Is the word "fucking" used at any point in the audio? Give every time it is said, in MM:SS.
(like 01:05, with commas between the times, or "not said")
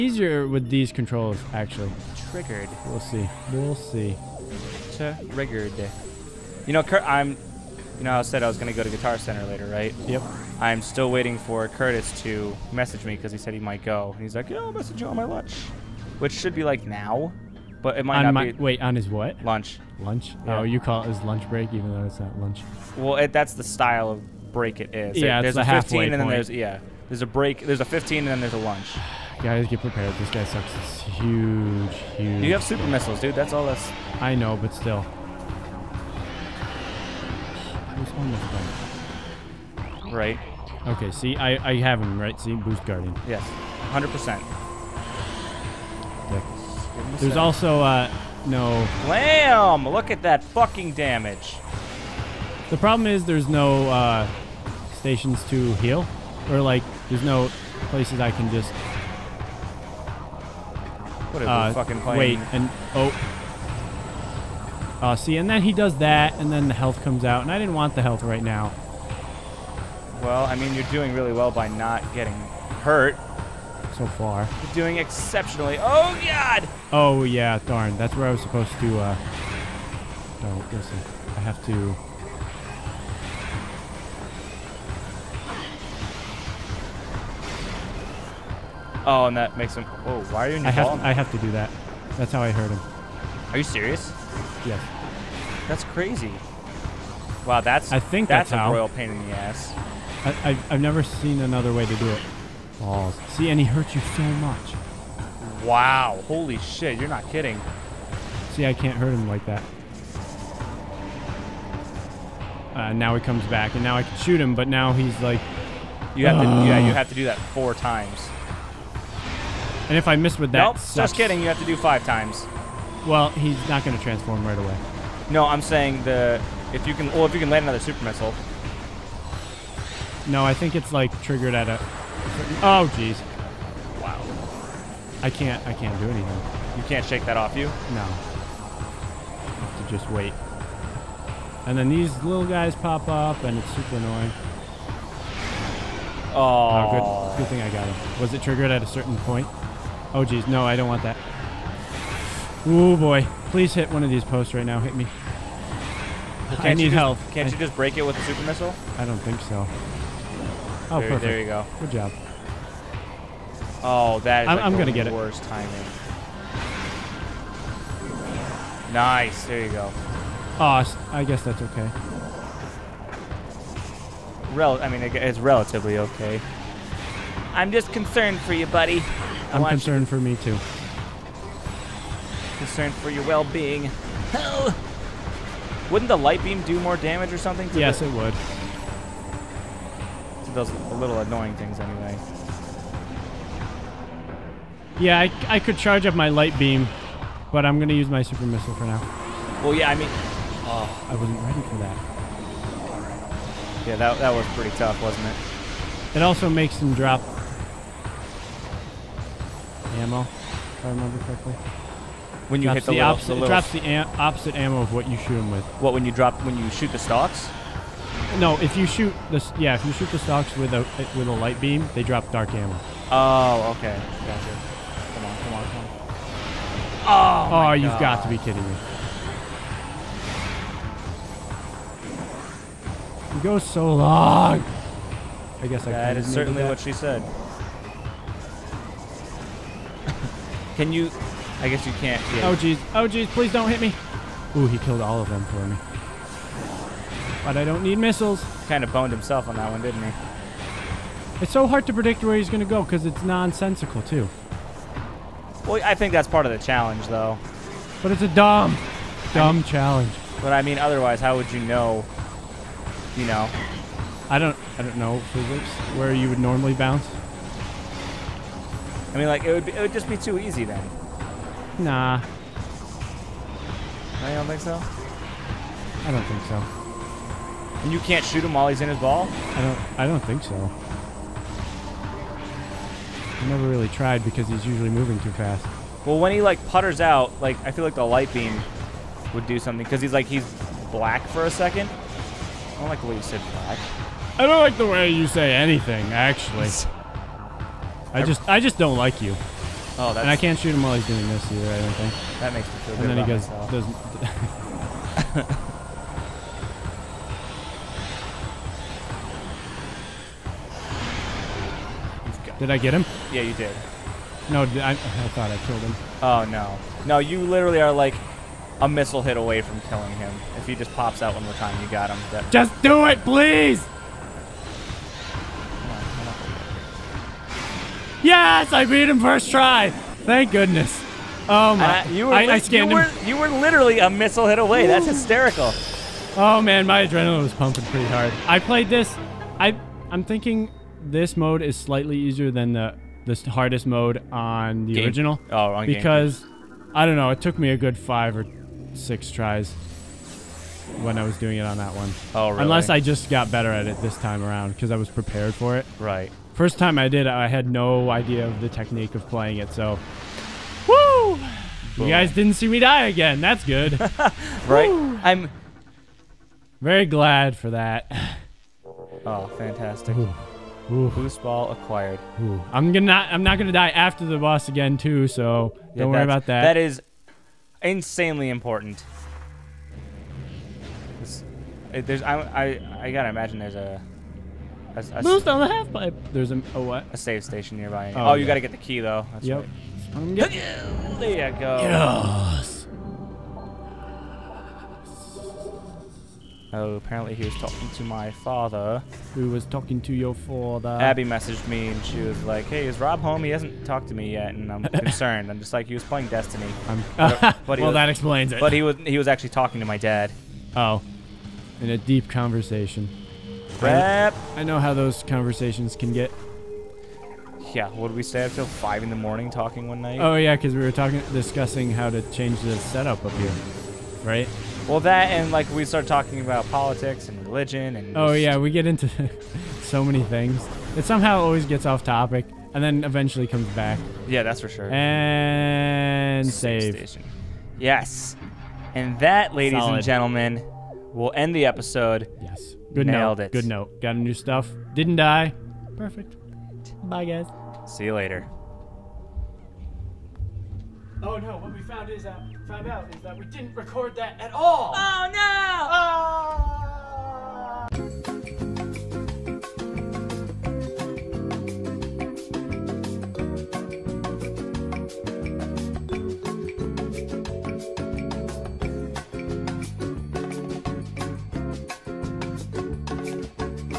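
00:50, 01:01.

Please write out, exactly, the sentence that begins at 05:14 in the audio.
No, I, I thought I killed him.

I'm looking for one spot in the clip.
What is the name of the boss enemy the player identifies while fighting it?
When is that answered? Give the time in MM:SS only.
00:42.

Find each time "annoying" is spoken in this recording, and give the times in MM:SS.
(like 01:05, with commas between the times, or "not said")
02:23, 03:11.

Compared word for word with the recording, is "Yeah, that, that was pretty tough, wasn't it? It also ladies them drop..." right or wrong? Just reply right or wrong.
wrong.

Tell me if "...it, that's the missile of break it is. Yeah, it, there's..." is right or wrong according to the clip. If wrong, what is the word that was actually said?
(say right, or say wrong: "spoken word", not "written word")
wrong: "style", not "missile".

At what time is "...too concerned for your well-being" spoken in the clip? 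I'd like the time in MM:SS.
03:00.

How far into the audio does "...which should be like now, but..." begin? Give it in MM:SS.
00:16.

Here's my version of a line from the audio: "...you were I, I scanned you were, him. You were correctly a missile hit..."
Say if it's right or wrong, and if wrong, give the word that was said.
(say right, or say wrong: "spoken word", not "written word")
wrong: "literally", not "correctly".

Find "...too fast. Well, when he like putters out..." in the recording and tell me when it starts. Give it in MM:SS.
04:45.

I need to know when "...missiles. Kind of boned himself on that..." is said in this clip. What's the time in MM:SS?
04:07.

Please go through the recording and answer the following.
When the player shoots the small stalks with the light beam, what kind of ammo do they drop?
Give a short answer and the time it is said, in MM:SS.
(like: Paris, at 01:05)
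dark ammo, at 03:42.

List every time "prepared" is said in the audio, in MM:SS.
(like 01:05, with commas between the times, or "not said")
00:29, 05:55.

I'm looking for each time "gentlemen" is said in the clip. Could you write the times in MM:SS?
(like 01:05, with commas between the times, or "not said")
07:20.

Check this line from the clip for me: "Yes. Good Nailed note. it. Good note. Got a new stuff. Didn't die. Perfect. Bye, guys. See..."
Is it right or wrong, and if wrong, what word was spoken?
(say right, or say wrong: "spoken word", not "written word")
right.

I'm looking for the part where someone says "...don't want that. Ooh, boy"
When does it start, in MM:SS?
02:30.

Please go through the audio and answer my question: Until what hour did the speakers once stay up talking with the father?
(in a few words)
5 in the morning.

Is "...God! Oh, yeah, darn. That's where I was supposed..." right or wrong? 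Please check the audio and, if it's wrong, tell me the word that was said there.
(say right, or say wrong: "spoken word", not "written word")
right.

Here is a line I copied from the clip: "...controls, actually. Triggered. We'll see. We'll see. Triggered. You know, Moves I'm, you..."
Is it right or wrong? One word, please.
wrong.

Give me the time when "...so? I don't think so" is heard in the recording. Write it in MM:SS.
04:34.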